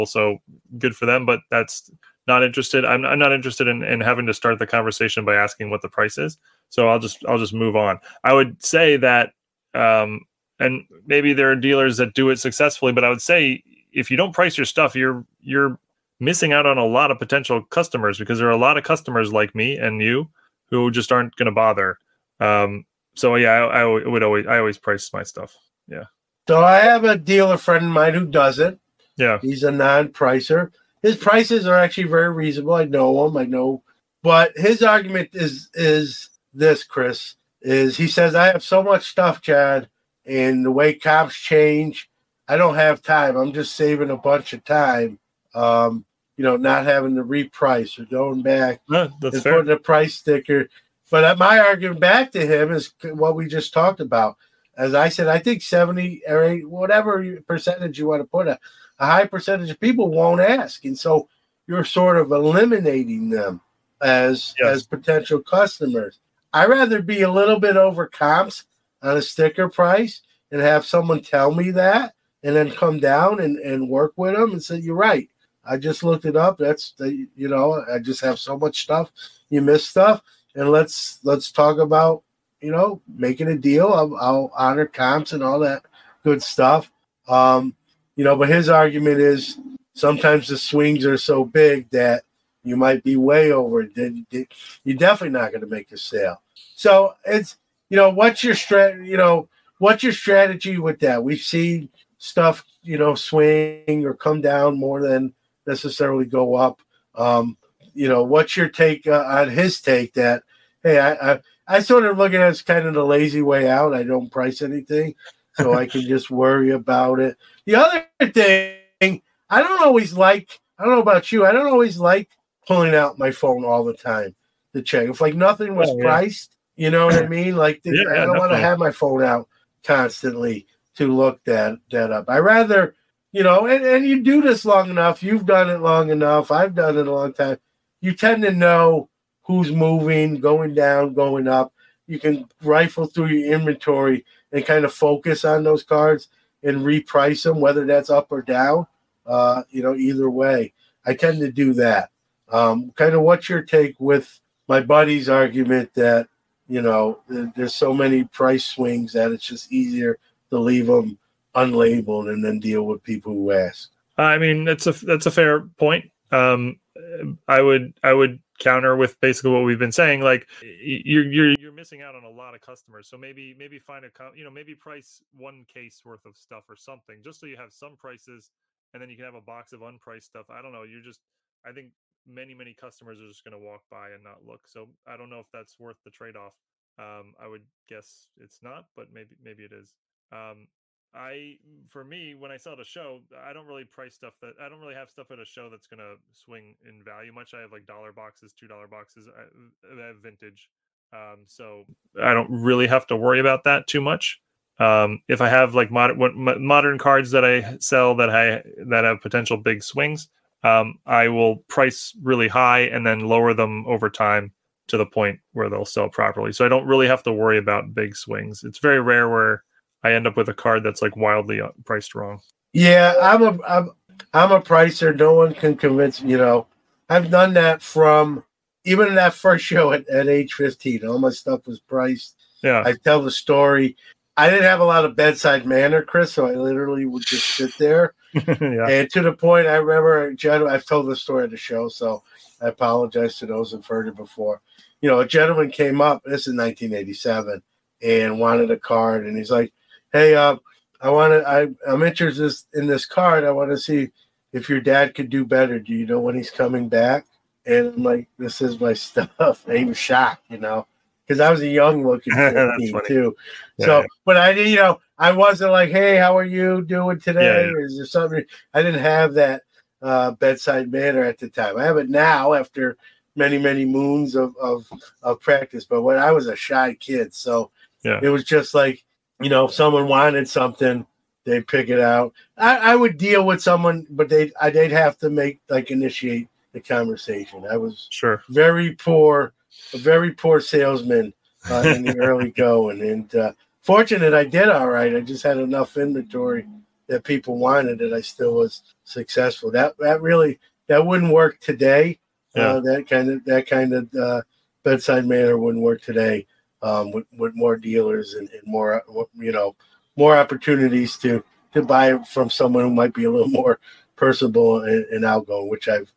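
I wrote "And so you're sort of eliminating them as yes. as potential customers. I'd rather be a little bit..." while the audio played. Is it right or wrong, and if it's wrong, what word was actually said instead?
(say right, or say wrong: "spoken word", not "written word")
right.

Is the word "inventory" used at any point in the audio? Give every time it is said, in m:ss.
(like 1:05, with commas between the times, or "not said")
2:23, 4:55.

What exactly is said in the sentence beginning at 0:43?
I'm just saving a bunch of time um, you know, not having to reprice or going back no, and fair.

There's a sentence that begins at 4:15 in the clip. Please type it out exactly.
Do you know when he's coming back?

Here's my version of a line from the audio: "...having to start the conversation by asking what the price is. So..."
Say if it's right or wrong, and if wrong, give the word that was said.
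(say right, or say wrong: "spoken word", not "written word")
right.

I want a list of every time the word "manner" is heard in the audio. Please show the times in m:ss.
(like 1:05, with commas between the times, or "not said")
3:55, 4:30, 5:05.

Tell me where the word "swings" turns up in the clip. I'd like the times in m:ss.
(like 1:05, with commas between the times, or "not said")
1:30, 1:43, 2:38, 3:16, 3:29, 3:38.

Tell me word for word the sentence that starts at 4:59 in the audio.
That that really that wouldn't work today.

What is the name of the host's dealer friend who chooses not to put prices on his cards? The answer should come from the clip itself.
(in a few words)
Chad.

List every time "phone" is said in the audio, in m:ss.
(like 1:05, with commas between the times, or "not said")
2:03, 2:08.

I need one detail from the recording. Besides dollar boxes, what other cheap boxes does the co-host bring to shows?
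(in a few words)
Two dollar boxes.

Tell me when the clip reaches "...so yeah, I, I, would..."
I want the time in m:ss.
0:23.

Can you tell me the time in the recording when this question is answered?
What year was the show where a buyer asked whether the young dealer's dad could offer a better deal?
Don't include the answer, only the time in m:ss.
4:06.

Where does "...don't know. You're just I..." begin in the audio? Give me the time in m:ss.
3:00.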